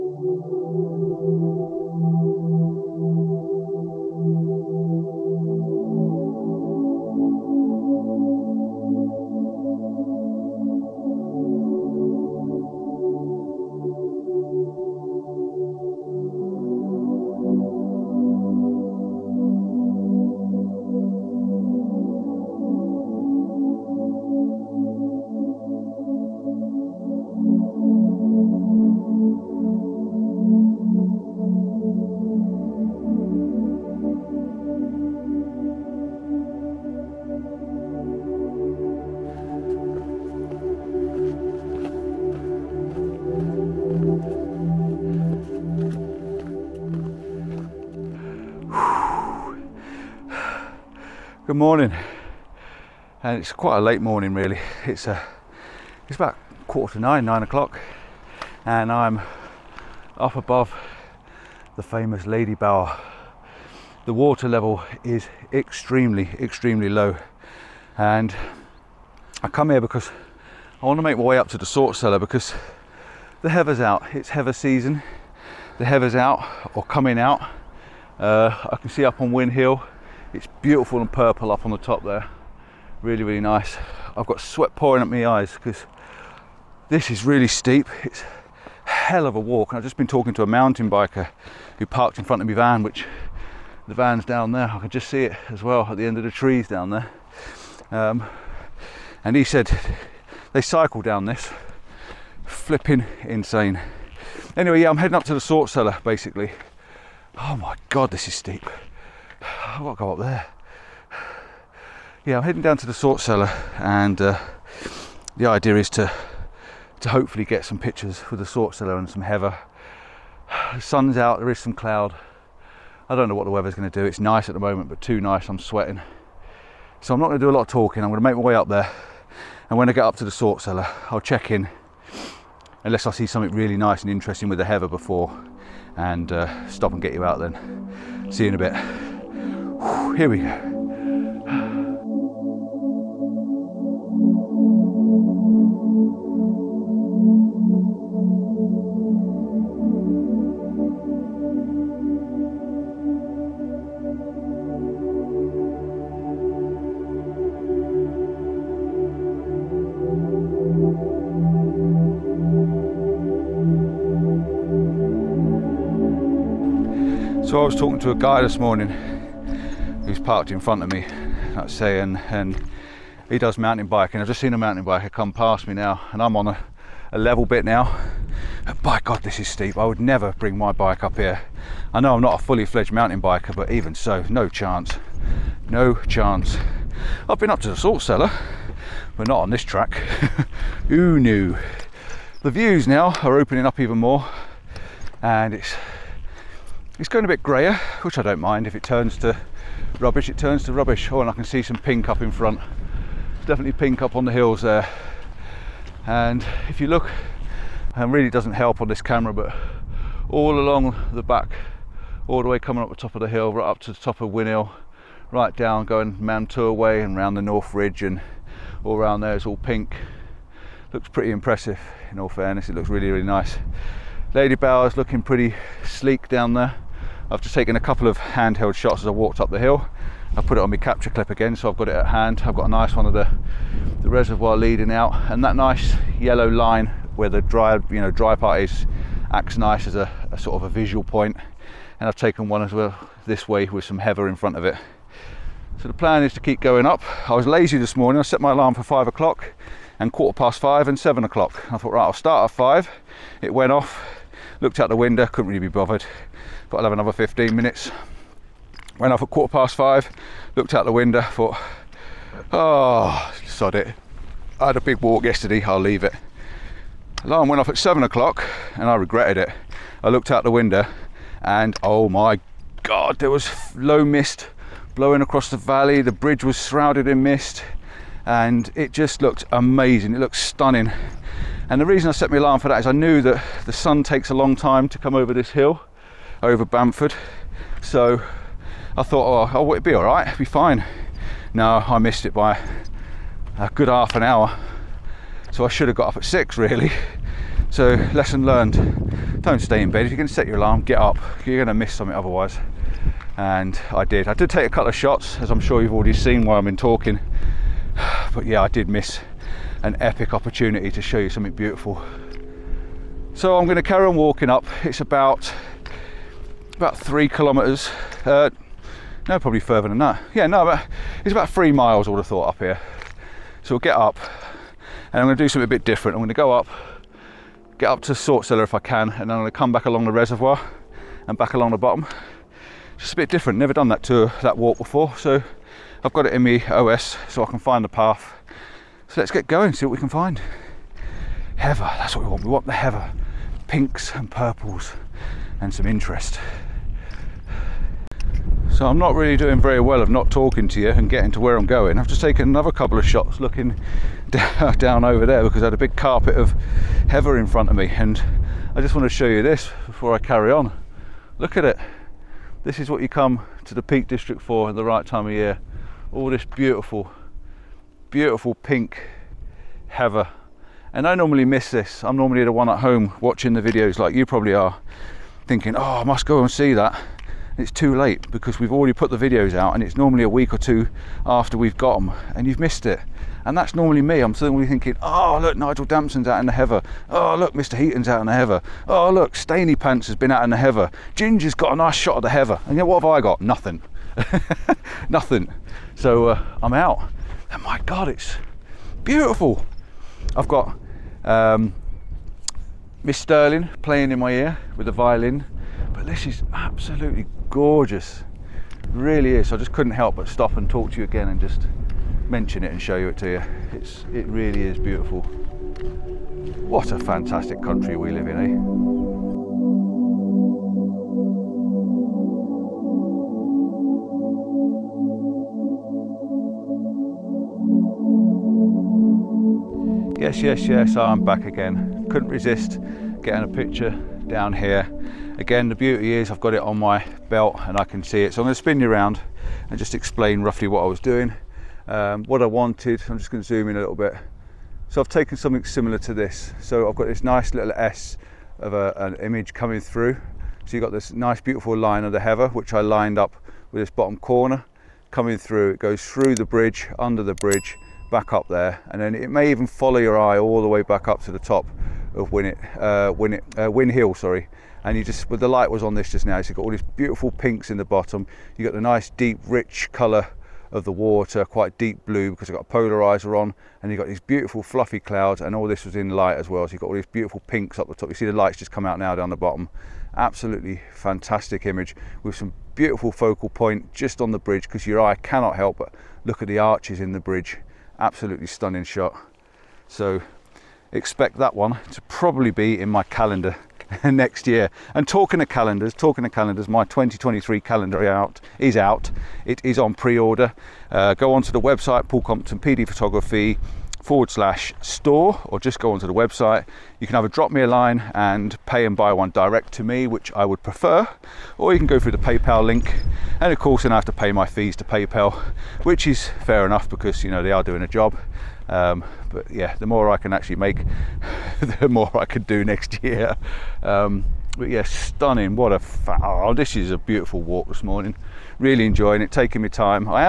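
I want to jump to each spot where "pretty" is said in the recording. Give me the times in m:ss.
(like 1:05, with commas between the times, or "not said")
3:41, 3:45.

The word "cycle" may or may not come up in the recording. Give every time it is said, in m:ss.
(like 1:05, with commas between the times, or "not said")
1:40.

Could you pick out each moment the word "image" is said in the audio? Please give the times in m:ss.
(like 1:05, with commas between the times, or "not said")
7:29, 8:01.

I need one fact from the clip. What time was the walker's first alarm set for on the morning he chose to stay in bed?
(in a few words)
5 o'clock.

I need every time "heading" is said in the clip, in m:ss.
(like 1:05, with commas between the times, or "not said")
1:44, 1:52.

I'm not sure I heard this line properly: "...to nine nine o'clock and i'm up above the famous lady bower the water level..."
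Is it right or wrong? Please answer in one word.
right.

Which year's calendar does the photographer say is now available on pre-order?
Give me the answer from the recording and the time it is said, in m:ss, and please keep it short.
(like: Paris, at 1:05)
2023, at 8:16.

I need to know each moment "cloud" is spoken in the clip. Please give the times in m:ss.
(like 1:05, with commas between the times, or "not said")
2:01, 7:54.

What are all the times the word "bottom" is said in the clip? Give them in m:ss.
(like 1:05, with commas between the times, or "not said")
5:31, 7:33, 7:47, 7:59.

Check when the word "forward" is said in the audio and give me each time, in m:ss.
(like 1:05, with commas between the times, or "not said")
8:24.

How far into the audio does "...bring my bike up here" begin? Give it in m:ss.
3:00.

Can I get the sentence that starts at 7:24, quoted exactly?
So I've taken something similar to this.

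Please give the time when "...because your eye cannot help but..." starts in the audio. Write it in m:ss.
8:04.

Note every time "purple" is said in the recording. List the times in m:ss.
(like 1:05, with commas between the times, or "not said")
1:21, 5:44.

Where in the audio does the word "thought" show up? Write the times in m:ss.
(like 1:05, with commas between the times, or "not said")
4:11, 4:21, 4:49, 5:22.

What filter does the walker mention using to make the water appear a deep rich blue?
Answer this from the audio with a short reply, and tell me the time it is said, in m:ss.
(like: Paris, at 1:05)
Polarizer, at 7:52.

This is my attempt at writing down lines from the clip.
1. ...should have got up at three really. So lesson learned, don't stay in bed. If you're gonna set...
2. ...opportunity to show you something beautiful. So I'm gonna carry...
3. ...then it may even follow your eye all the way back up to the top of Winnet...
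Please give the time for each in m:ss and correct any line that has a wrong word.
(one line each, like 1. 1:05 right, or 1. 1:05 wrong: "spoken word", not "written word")
1. 4:55 wrong: "six", not "three"
2. 5:10 right
3. 7:39 right.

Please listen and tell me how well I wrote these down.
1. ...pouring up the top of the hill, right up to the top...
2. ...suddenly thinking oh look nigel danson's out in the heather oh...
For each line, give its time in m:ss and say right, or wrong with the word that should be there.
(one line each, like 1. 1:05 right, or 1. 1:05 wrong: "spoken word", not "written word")
1. 3:32 wrong: "coming", not "pouring"
2. 6:24 right.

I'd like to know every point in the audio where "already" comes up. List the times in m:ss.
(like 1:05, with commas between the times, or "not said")
5:05, 6:18.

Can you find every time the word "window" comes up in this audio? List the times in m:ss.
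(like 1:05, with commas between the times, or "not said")
4:14, 4:20, 4:30.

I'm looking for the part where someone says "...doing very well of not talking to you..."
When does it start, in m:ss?
5:49.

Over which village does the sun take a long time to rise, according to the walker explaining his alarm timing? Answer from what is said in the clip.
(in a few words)
Bamford.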